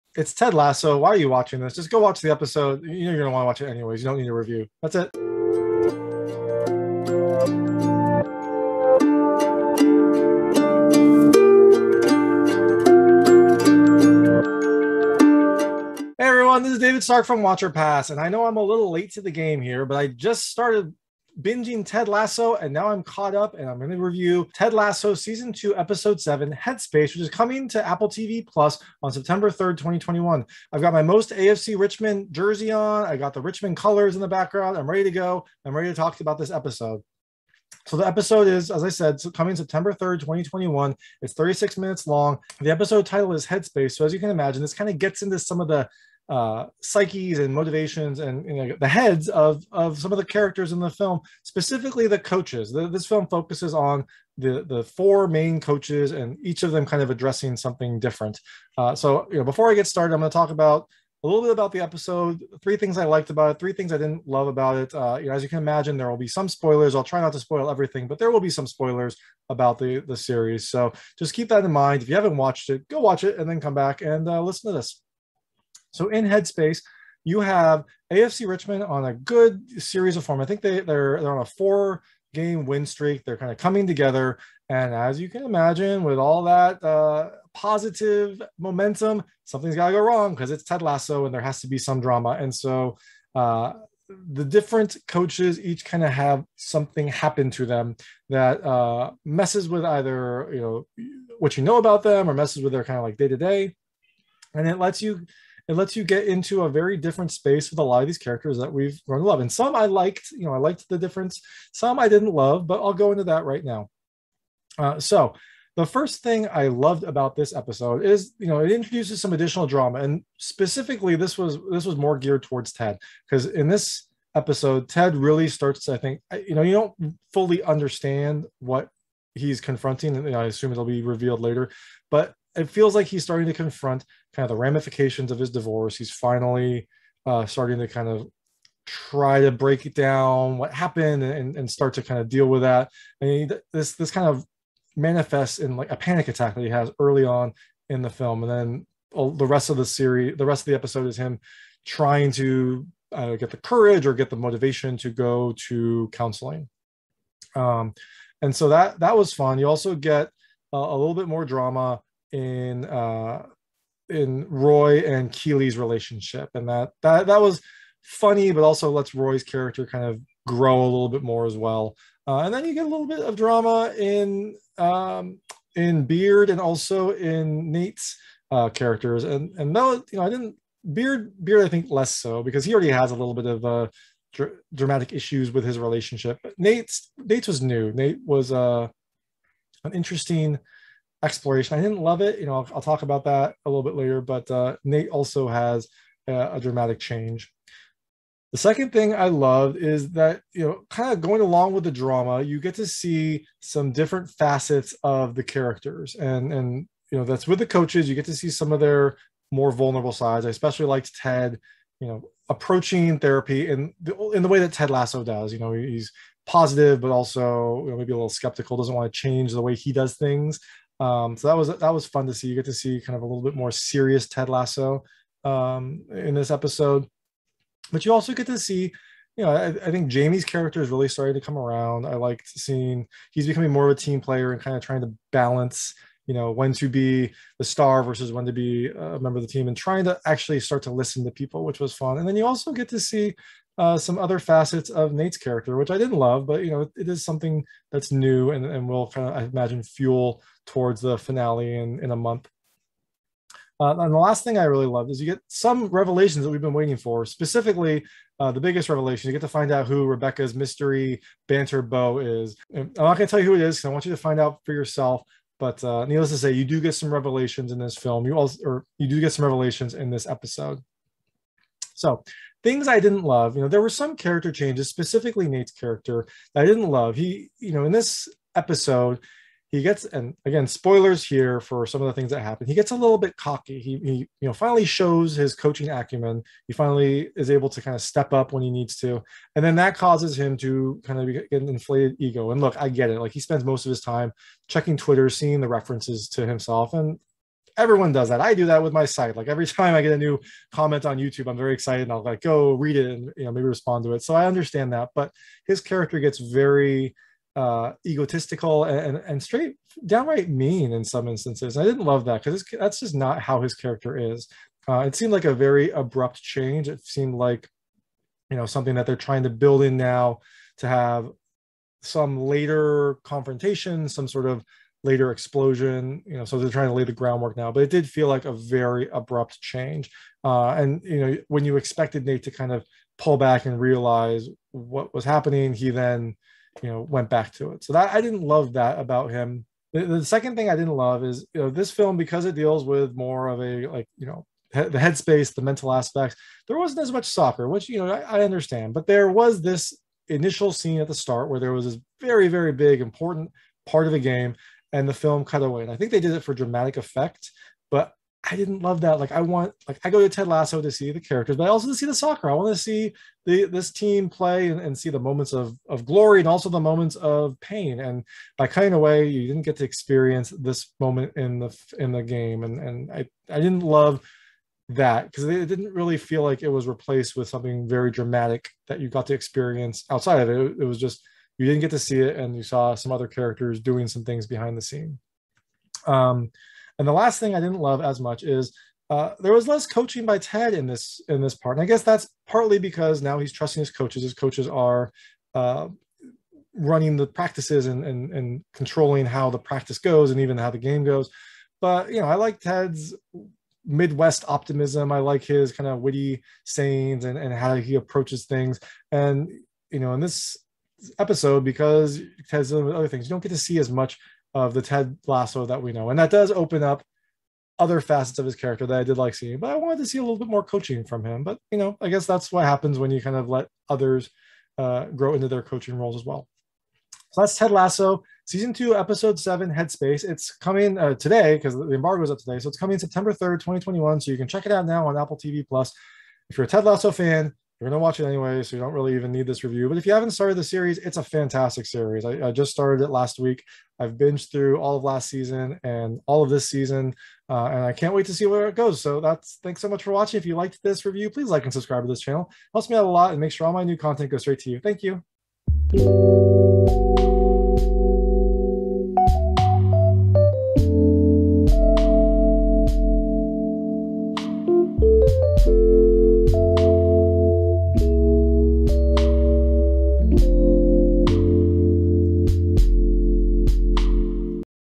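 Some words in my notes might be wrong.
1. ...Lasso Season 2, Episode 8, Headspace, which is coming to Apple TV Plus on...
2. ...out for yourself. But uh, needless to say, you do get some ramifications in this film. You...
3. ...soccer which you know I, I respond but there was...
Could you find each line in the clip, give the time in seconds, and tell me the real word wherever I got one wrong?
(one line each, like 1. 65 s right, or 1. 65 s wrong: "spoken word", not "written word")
1. 24 s wrong: "7", not "8"
2. 264 s wrong: "revelations", not "ramifications"
3. 347 s wrong: "understand", not "respond".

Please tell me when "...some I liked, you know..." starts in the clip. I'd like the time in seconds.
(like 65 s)
109 s.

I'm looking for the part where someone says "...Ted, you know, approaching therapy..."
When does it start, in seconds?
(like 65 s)
211 s.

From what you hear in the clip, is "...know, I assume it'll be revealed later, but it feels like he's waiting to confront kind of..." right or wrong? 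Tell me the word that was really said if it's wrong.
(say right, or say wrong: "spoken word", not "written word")
wrong: "starting", not "waiting".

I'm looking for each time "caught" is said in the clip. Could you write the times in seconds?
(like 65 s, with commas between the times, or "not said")
23 s.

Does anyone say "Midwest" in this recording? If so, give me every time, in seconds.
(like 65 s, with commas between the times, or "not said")
403 s.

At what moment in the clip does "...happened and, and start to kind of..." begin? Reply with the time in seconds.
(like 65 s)
140 s.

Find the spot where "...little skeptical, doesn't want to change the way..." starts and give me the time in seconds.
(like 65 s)
218 s.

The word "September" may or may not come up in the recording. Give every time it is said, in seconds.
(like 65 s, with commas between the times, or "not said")
29 s, 39 s, 432 s.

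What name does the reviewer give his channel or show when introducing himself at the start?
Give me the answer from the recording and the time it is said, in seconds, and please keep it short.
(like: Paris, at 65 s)
Watch or Pass, at 17 s.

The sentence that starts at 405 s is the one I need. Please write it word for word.
I like his kind of witty sayings and, and how he approaches things.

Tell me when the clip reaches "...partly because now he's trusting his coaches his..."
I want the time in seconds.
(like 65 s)
392 s.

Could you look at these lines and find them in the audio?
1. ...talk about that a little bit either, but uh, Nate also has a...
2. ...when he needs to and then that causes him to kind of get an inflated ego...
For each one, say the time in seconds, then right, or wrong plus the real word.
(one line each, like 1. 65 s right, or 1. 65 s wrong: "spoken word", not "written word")
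1. 192 s wrong: "later", not "either"
2. 288 s right.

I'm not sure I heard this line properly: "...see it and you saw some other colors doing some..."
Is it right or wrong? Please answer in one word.
wrong.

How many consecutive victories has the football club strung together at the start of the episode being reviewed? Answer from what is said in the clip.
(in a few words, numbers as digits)
4.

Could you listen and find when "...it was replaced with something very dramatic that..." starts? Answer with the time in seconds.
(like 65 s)
376 s.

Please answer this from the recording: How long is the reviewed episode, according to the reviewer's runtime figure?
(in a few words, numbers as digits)
36 minutes.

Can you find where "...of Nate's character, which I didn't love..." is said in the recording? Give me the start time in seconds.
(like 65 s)
244 s.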